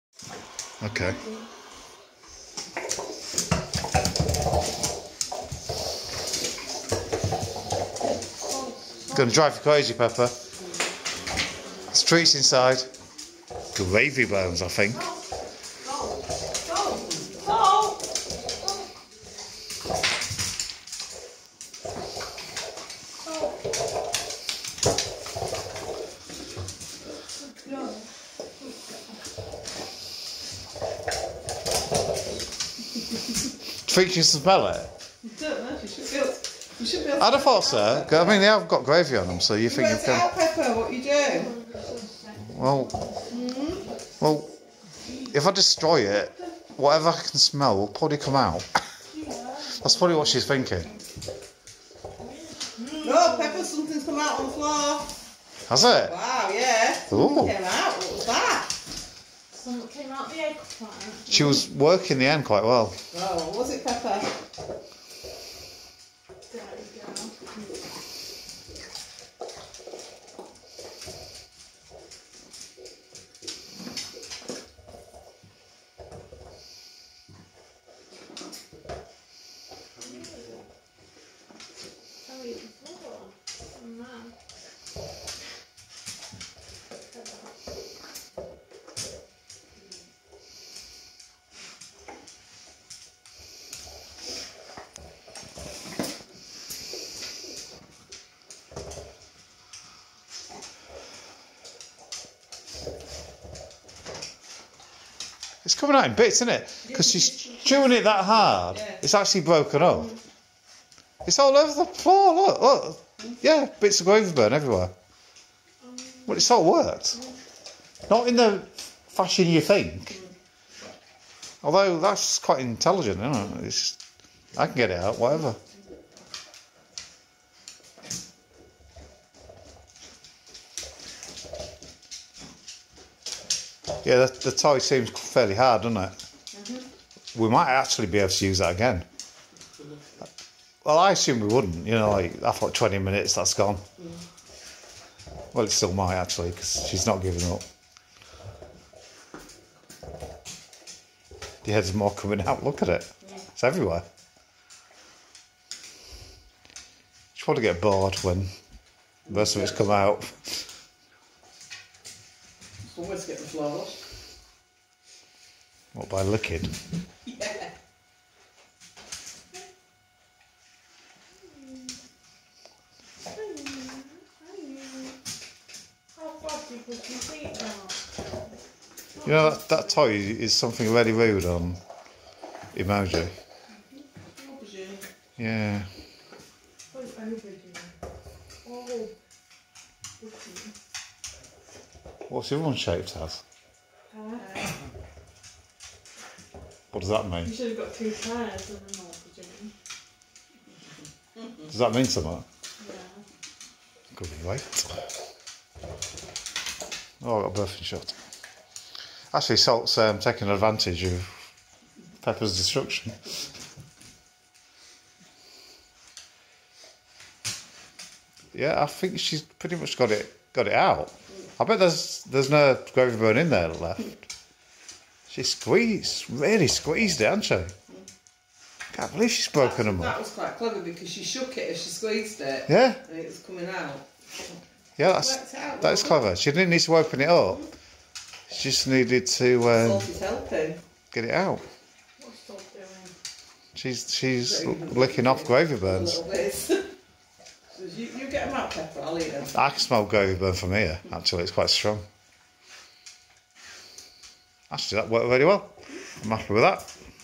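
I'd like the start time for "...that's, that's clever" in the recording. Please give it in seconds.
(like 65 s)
235 s.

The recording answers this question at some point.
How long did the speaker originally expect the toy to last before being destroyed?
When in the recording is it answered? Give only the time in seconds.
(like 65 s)
142 s.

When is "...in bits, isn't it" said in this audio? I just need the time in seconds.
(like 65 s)
106 s.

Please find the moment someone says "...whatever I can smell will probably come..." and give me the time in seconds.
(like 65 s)
46 s.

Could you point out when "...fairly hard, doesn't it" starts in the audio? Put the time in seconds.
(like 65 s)
135 s.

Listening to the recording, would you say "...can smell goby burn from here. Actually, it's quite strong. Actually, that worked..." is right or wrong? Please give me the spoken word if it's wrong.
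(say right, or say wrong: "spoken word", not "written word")
right.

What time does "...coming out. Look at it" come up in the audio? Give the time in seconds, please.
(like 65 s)
152 s.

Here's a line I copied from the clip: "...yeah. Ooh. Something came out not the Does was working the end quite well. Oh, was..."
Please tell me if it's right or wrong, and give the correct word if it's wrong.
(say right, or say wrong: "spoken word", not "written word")
wrong: "She", not "Does".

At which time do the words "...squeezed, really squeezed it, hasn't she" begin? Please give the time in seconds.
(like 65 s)
225 s.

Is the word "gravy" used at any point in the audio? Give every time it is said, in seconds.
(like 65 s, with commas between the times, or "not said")
13 s, 38 s, 222 s, 245 s.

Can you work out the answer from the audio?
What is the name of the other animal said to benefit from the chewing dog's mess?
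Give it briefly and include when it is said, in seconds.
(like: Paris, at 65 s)
Salt, at 209 s.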